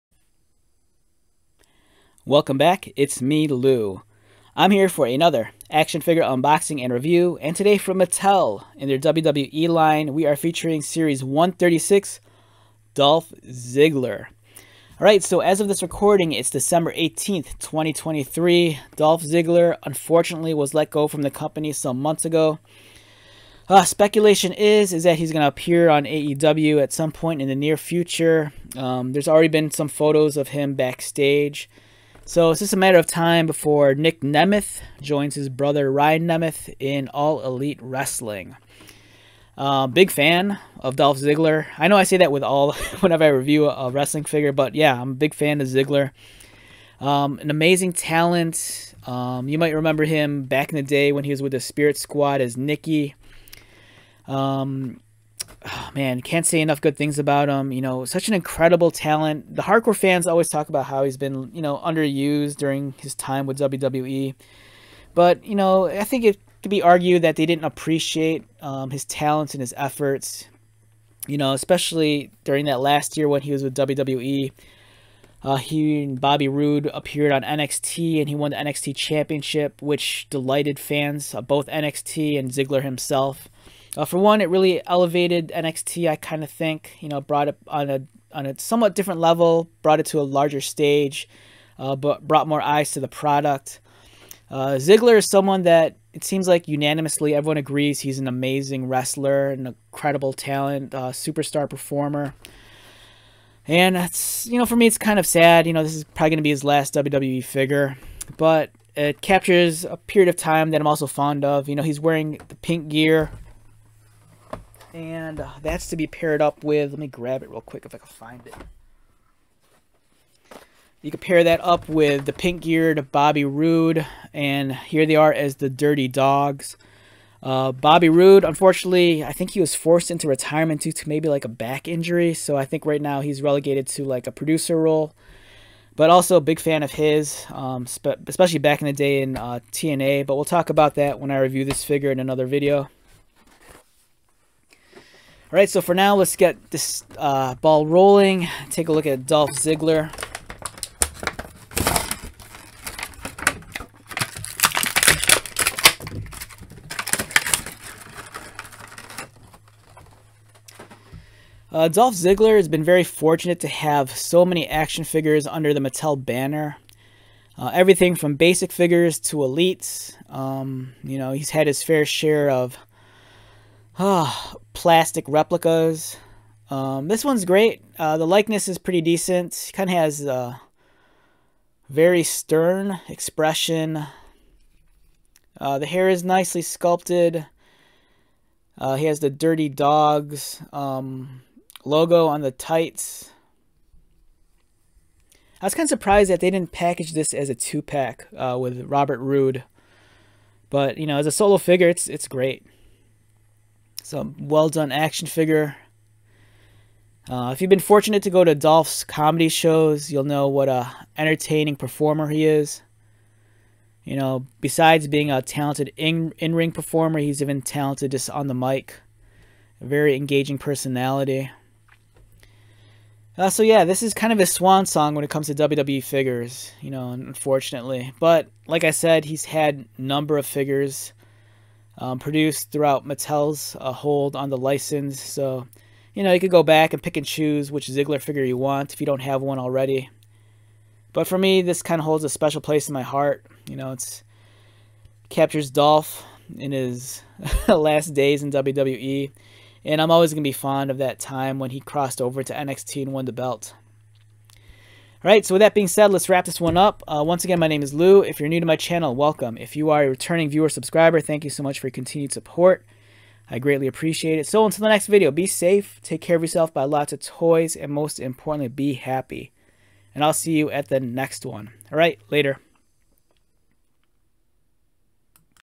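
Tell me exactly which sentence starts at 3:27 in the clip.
Uh, if you've been fortunate to go to Dolph's comedy shows, you'll know what a entertaining performer he is.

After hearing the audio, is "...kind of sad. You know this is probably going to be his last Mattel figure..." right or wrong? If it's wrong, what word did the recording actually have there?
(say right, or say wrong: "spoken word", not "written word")
wrong: "WWE", not "Mattel".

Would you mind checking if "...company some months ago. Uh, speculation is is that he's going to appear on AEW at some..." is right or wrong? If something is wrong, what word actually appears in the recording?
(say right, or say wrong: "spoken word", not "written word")
right.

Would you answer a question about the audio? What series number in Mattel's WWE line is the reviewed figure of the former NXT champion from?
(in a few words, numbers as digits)
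136.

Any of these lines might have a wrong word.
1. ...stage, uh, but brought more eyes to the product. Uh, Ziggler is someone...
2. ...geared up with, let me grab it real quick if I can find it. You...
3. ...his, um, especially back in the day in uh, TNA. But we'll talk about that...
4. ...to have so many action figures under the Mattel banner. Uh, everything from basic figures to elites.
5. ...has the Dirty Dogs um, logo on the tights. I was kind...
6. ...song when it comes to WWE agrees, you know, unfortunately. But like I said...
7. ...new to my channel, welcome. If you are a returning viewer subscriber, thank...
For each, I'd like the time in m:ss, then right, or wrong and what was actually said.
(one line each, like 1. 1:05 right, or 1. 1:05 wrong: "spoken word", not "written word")
1. 1:30 right
2. 1:56 wrong: "paired", not "geared"
3. 2:16 right
4. 2:43 right
5. 3:09 right
6. 3:44 wrong: "figures", not "agrees"
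7. 4:18 right.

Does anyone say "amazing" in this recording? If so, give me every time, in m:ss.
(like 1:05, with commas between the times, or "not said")
0:47, 1:38.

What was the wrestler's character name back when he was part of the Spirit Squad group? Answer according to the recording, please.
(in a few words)
Nikki.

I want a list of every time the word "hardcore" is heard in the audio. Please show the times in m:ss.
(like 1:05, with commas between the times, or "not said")
0:59.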